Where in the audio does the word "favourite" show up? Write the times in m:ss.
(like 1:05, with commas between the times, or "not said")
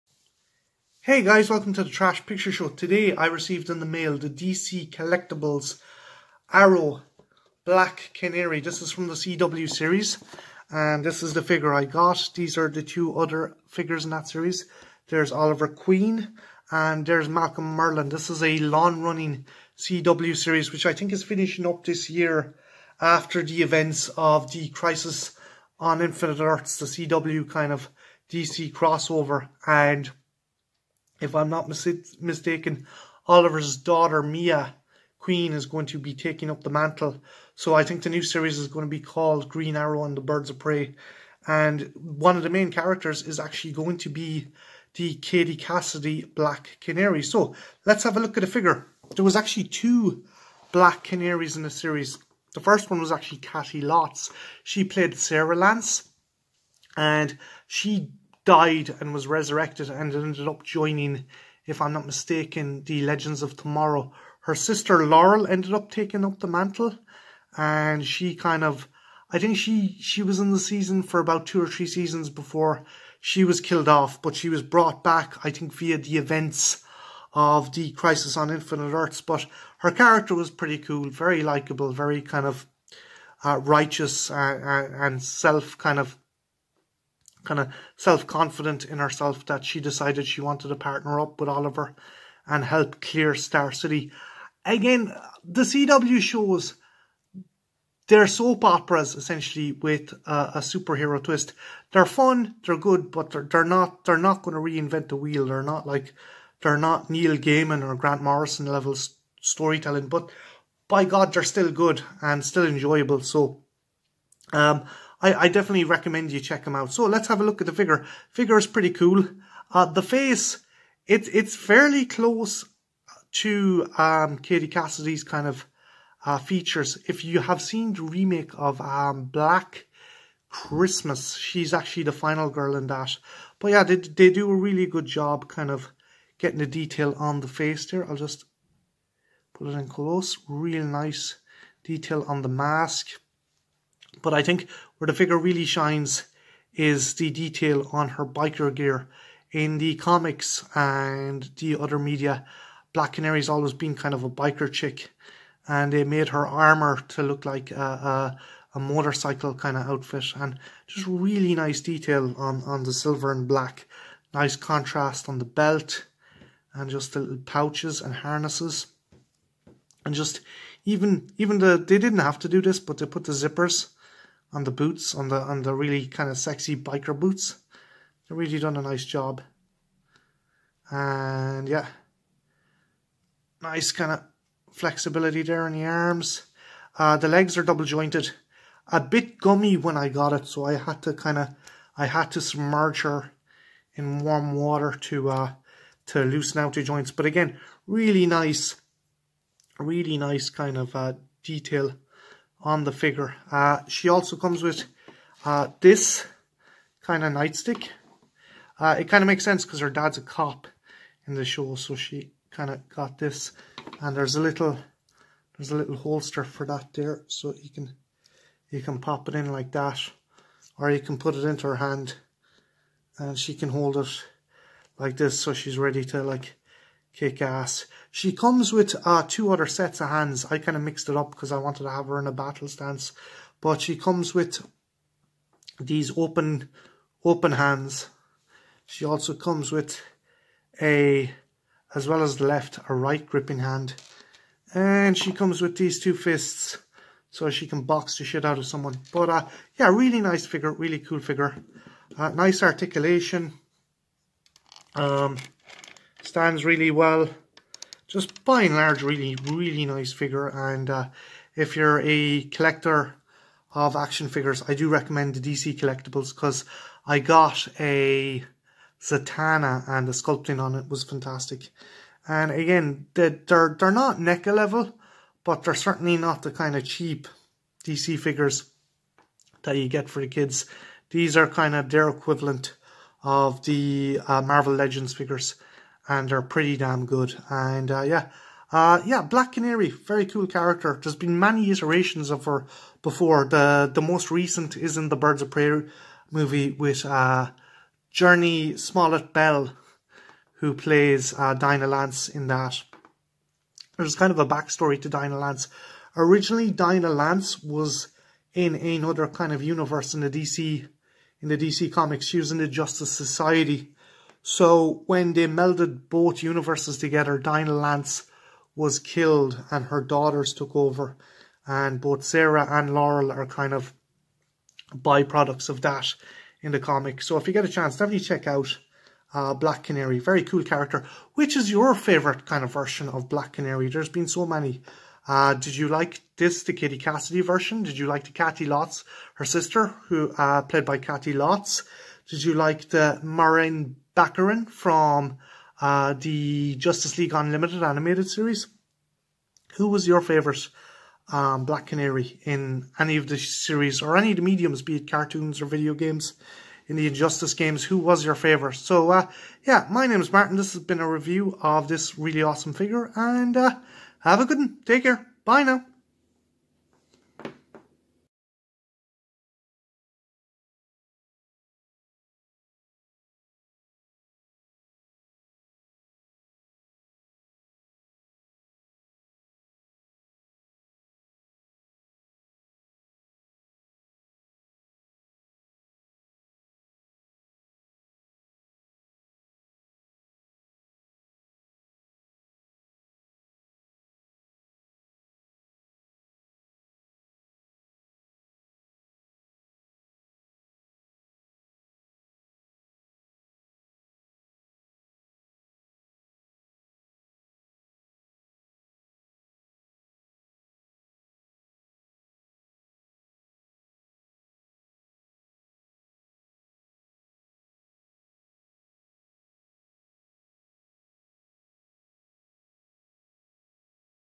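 5:31, 5:50, 5:58.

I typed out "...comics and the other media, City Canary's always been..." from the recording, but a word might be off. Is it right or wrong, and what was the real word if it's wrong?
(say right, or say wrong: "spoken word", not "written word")
wrong: "Black", not "City".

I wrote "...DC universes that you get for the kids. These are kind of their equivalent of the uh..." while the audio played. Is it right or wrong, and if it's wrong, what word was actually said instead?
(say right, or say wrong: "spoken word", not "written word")
wrong: "figures", not "universes".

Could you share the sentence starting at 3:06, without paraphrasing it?
Uh, the legs are double jointed.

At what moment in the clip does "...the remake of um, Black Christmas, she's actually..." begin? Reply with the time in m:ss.
2:07.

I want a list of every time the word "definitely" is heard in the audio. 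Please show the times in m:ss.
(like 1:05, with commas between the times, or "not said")
1:55, 5:27.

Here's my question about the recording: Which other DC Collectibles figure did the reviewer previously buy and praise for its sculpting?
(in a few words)
Zatanna.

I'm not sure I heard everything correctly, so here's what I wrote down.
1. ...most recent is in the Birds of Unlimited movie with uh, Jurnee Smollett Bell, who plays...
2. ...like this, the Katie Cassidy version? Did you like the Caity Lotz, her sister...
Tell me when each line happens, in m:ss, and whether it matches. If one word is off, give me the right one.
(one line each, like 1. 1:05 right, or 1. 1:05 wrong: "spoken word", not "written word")
1. 4:54 wrong: "Prey", not "Unlimited"
2. 5:35 right.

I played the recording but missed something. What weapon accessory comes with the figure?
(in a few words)
Nightstick.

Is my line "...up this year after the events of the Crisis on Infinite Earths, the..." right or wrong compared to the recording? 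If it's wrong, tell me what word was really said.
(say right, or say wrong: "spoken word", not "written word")
right.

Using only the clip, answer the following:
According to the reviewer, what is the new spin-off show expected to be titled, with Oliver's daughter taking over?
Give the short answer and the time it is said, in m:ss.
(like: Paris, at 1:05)
Green Arrow and the Birds of Prey, at 0:39.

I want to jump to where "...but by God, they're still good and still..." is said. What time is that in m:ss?
1:50.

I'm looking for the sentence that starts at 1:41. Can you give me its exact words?
They're fun, they're good, but they're, they're not they're not going to reinvent the wheel.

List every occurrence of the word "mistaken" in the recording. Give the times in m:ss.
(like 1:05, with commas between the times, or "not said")
0:32, 1:02.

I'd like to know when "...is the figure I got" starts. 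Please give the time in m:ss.
0:11.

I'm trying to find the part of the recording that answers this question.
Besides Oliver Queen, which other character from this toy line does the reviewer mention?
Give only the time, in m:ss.
0:17.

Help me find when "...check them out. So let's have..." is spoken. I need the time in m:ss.
1:56.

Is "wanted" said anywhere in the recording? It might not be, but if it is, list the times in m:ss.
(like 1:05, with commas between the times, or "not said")
1:30, 3:51.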